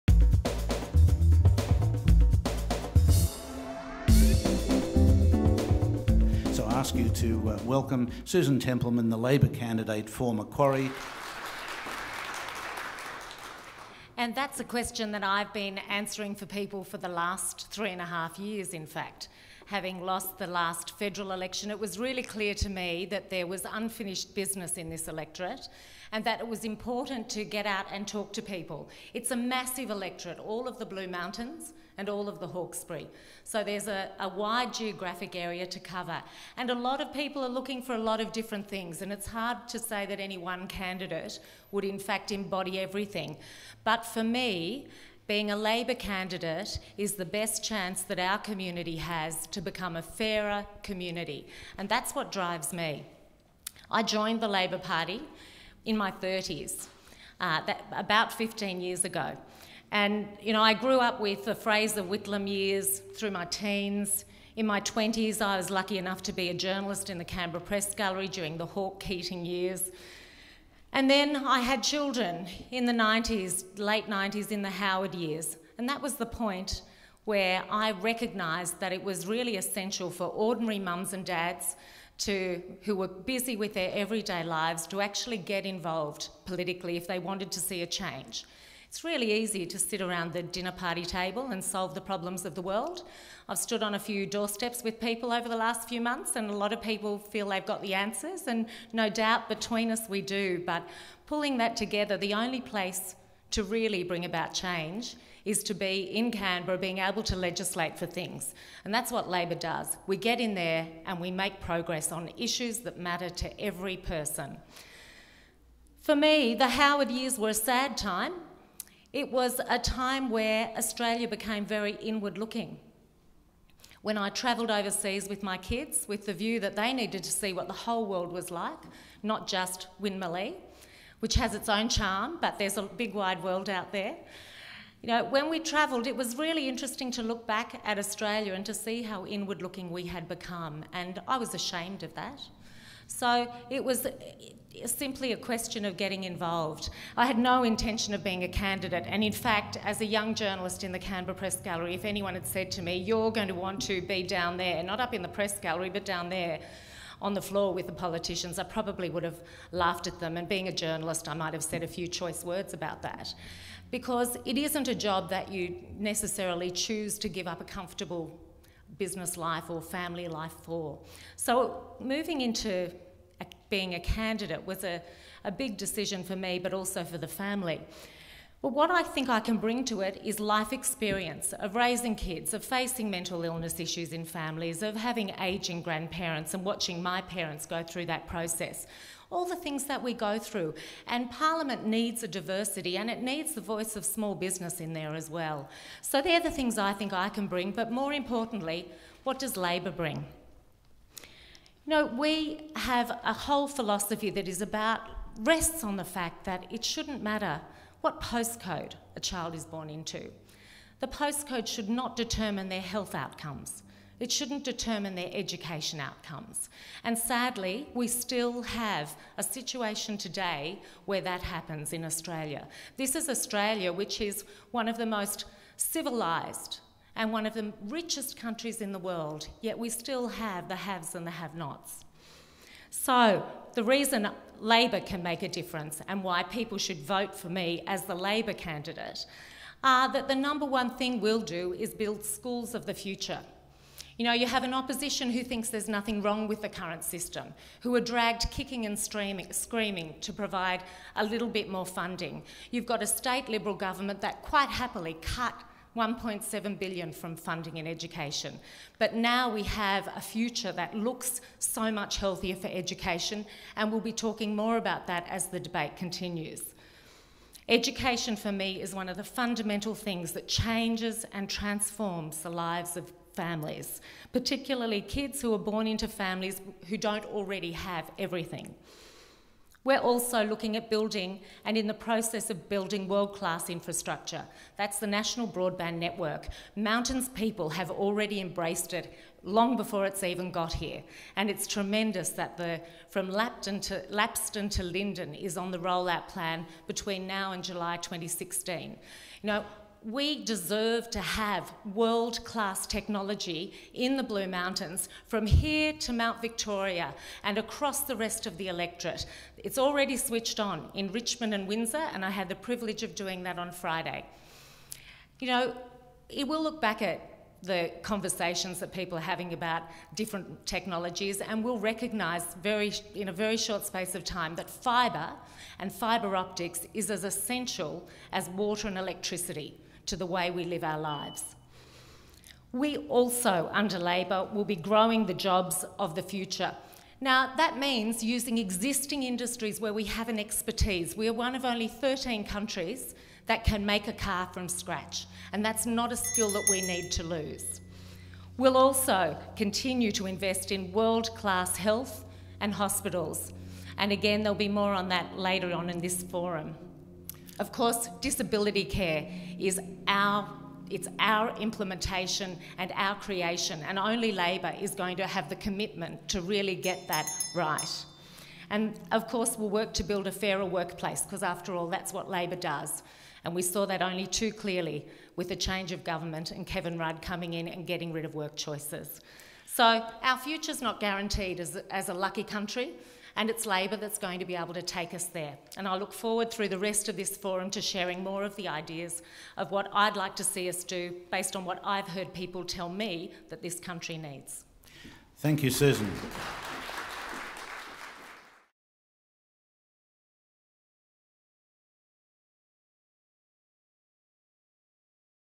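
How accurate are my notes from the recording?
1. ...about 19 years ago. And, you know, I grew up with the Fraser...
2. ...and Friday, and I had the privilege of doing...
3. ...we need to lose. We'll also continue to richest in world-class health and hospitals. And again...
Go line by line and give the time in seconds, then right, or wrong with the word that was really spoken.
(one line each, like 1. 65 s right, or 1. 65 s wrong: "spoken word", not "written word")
1. 57 s wrong: "15", not "19"
2. 311 s wrong: "Windsor", not "Friday"
3. 346 s wrong: "invest", not "richest".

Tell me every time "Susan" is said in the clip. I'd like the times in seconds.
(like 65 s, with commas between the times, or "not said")
8 s, 395 s.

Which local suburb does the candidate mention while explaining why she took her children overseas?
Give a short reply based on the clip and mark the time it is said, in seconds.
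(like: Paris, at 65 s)
Winmalee, at 130 s.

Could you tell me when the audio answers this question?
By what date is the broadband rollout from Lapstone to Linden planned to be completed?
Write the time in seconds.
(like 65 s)
297 s.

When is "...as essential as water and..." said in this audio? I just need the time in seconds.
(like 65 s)
327 s.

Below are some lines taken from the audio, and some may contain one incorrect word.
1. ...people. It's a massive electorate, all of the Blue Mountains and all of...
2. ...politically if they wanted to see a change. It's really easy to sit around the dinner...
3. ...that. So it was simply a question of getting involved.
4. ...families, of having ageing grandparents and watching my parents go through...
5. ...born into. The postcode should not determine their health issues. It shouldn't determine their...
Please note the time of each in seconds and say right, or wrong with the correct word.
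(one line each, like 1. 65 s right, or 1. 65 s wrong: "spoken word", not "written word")
1. 28 s right
2. 86 s right
3. 142 s right
4. 184 s right
5. 209 s wrong: "outcomes", not "issues".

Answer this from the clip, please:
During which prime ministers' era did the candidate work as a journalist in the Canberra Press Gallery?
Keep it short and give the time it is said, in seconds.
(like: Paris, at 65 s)
Hawke Keating years, at 68 s.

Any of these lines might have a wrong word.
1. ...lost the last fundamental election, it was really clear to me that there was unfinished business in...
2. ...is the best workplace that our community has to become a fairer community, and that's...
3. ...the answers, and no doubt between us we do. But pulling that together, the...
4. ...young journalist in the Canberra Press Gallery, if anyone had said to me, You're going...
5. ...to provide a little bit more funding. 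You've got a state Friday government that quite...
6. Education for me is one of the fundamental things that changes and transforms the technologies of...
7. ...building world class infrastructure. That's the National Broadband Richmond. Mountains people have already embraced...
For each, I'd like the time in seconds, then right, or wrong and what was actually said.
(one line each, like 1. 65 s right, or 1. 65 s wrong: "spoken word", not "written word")
1. 20 s wrong: "federal", not "fundamental"
2. 46 s wrong: "chance", not "workplace"
3. 97 s right
4. 150 s right
5. 250 s wrong: "Liberal", not "Friday"
6. 267 s wrong: "lives", not "technologies"
7. 282 s wrong: "Network", not "Richmond".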